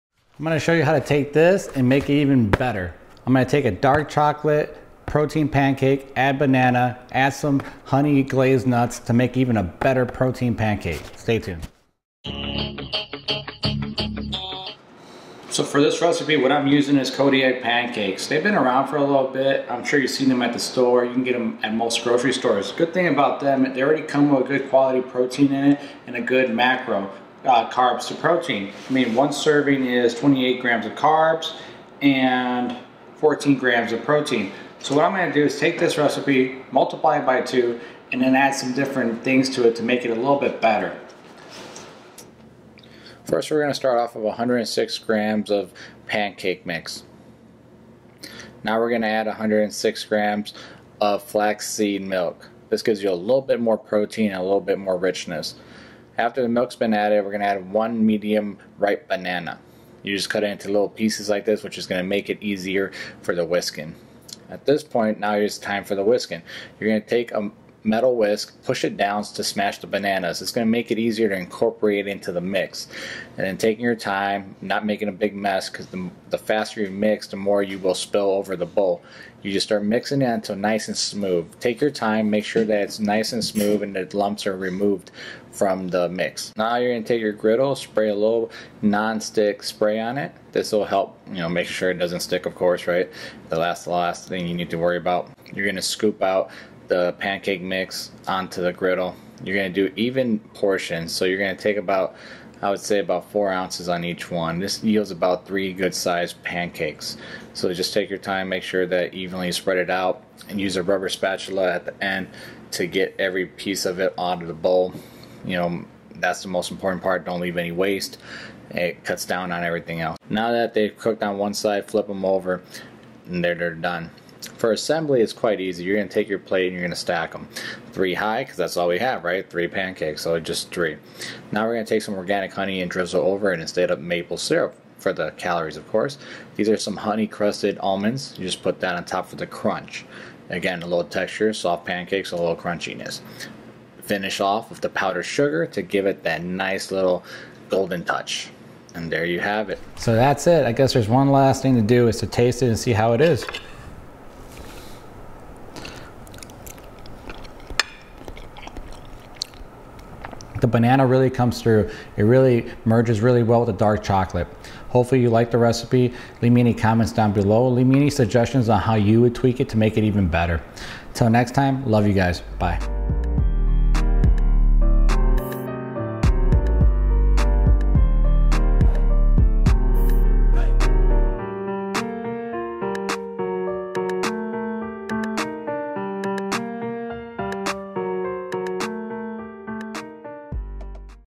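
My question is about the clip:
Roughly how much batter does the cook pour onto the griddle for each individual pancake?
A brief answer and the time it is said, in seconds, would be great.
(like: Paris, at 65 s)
4 ounces, at 103 s.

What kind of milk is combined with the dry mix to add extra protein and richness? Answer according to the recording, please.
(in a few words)
flaxseed milk.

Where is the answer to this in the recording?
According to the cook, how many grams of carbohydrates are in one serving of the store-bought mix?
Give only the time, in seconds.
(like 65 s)
30 s.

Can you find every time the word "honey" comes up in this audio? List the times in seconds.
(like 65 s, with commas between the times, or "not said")
7 s, 132 s, 136 s.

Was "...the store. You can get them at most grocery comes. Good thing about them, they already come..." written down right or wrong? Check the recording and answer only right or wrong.
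wrong.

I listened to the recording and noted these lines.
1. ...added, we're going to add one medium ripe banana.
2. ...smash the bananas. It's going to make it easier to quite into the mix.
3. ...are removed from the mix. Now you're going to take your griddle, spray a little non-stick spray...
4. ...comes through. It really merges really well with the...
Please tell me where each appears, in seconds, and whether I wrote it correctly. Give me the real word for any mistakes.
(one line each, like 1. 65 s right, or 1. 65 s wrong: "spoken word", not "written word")
1. 56 s right
2. 69 s wrong: "incorporate", not "quite"
3. 84 s right
4. 161 s right.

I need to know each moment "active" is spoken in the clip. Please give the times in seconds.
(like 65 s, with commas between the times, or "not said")
not said.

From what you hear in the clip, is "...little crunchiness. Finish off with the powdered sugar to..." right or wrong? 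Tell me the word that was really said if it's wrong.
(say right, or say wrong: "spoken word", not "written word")
right.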